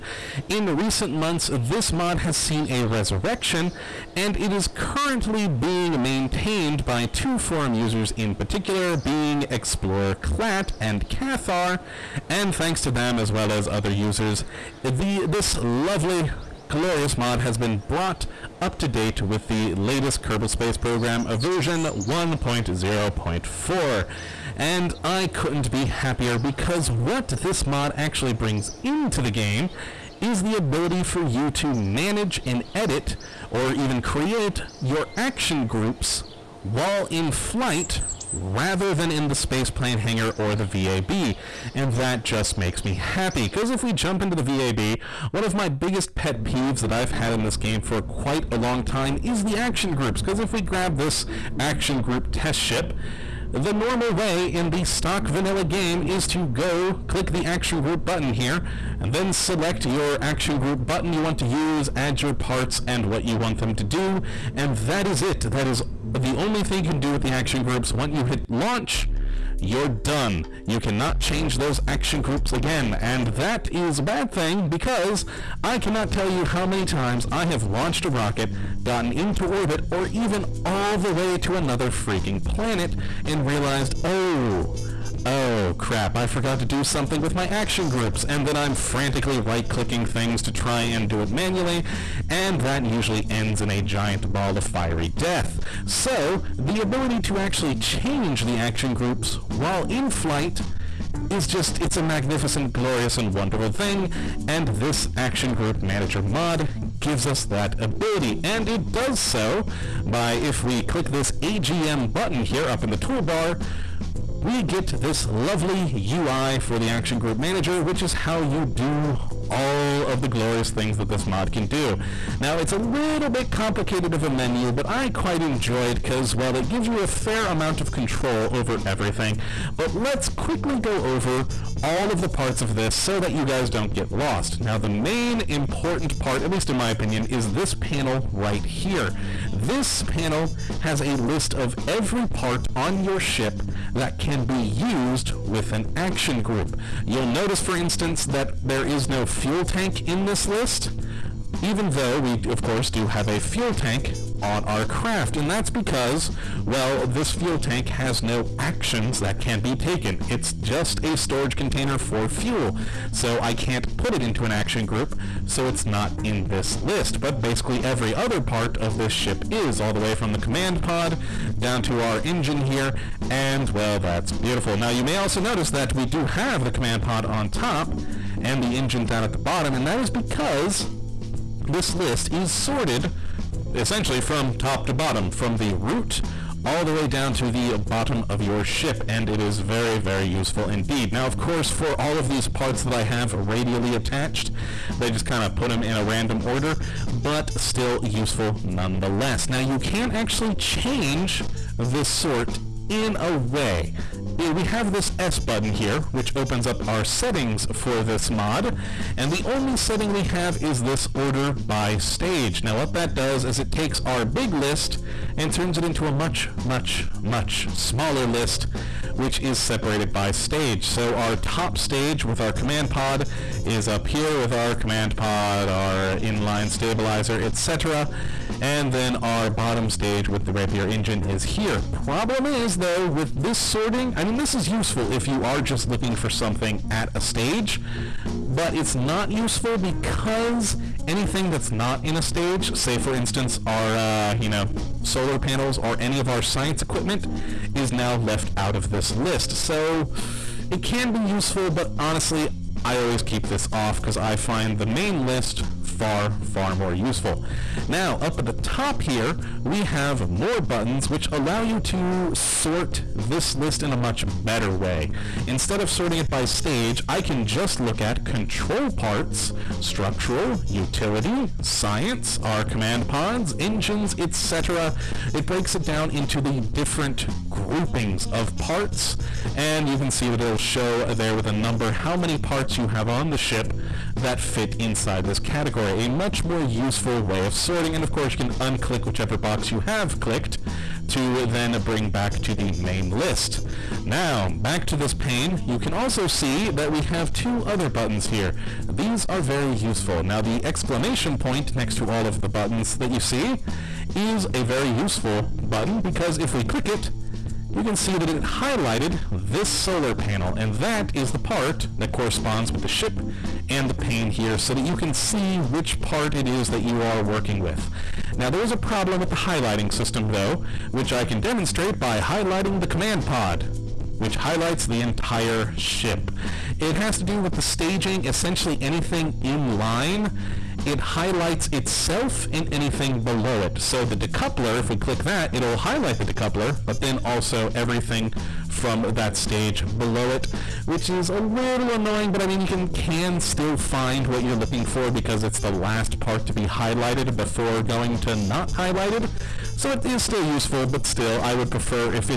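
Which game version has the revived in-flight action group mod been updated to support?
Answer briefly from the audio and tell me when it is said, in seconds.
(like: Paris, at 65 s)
1.0.4, at 21 s.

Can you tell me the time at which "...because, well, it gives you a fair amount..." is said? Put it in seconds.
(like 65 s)
126 s.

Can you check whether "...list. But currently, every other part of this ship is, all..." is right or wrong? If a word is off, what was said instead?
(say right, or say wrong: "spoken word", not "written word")
wrong: "basically", not "currently".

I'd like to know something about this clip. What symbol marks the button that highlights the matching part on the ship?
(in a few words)
exclamation point.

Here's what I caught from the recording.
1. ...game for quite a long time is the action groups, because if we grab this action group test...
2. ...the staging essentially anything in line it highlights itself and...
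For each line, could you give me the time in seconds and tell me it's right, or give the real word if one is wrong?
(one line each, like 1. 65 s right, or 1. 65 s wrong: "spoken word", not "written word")
1. 47 s right
2. 327 s right.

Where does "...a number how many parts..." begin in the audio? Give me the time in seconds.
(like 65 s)
281 s.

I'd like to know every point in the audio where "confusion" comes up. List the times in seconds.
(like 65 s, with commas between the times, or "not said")
not said.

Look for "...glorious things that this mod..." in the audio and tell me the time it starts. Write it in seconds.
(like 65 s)
120 s.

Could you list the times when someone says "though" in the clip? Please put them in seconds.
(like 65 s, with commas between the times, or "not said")
151 s, 232 s, 320 s.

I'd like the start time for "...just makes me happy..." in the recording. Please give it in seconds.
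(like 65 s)
42 s.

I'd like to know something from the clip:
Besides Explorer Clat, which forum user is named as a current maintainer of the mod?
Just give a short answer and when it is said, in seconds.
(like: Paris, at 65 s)
Cathar, at 11 s.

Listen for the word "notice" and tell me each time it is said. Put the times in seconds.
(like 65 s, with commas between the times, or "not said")
147 s, 175 s.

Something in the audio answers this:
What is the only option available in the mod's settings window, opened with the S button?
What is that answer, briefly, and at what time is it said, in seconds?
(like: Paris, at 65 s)
order by stage, at 211 s.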